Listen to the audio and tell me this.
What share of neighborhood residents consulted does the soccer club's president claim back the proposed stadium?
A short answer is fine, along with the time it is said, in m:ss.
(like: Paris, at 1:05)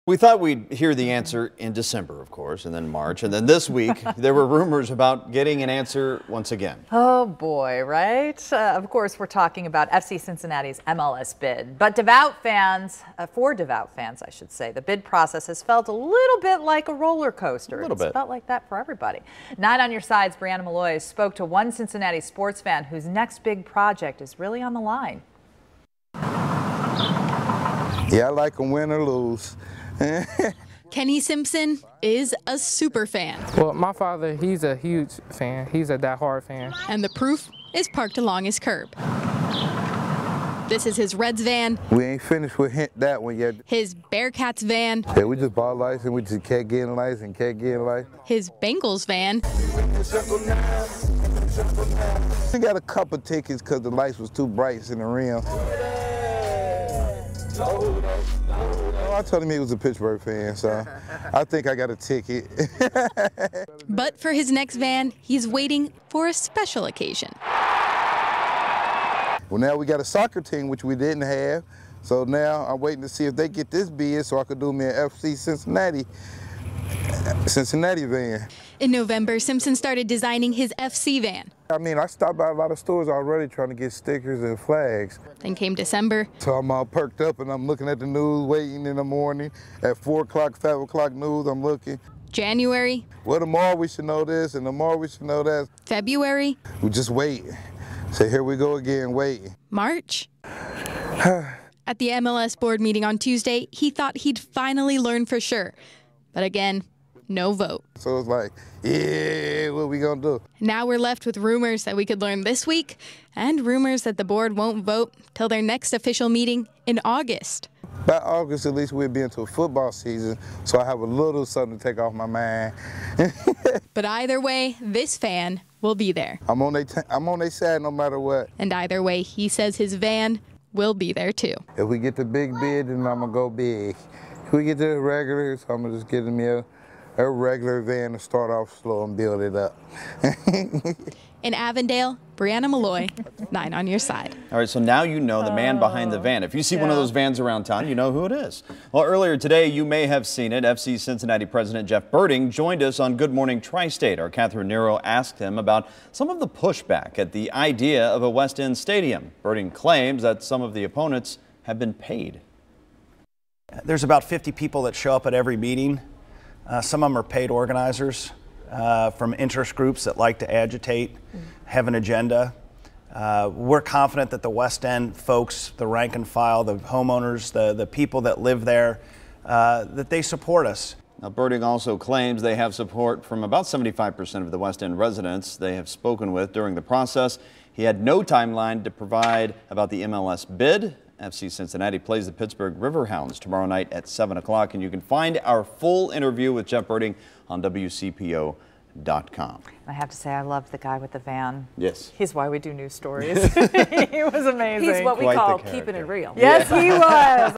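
75%, at 3:03.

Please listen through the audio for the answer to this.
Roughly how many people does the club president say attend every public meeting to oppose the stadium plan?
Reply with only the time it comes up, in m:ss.
2:44.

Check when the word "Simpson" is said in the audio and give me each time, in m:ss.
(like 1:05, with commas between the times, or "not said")
0:31, 1:19.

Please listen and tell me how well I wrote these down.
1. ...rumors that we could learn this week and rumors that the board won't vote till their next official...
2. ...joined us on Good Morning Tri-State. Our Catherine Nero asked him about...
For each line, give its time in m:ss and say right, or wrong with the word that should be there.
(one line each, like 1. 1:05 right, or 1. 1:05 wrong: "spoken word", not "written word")
1. 1:51 right
2. 2:32 right.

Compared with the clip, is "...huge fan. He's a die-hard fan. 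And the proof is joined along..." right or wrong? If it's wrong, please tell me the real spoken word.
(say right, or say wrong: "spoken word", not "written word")
wrong: "parked", not "joined".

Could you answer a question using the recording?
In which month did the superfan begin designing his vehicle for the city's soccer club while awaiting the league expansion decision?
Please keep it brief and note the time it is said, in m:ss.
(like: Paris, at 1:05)
November, at 1:18.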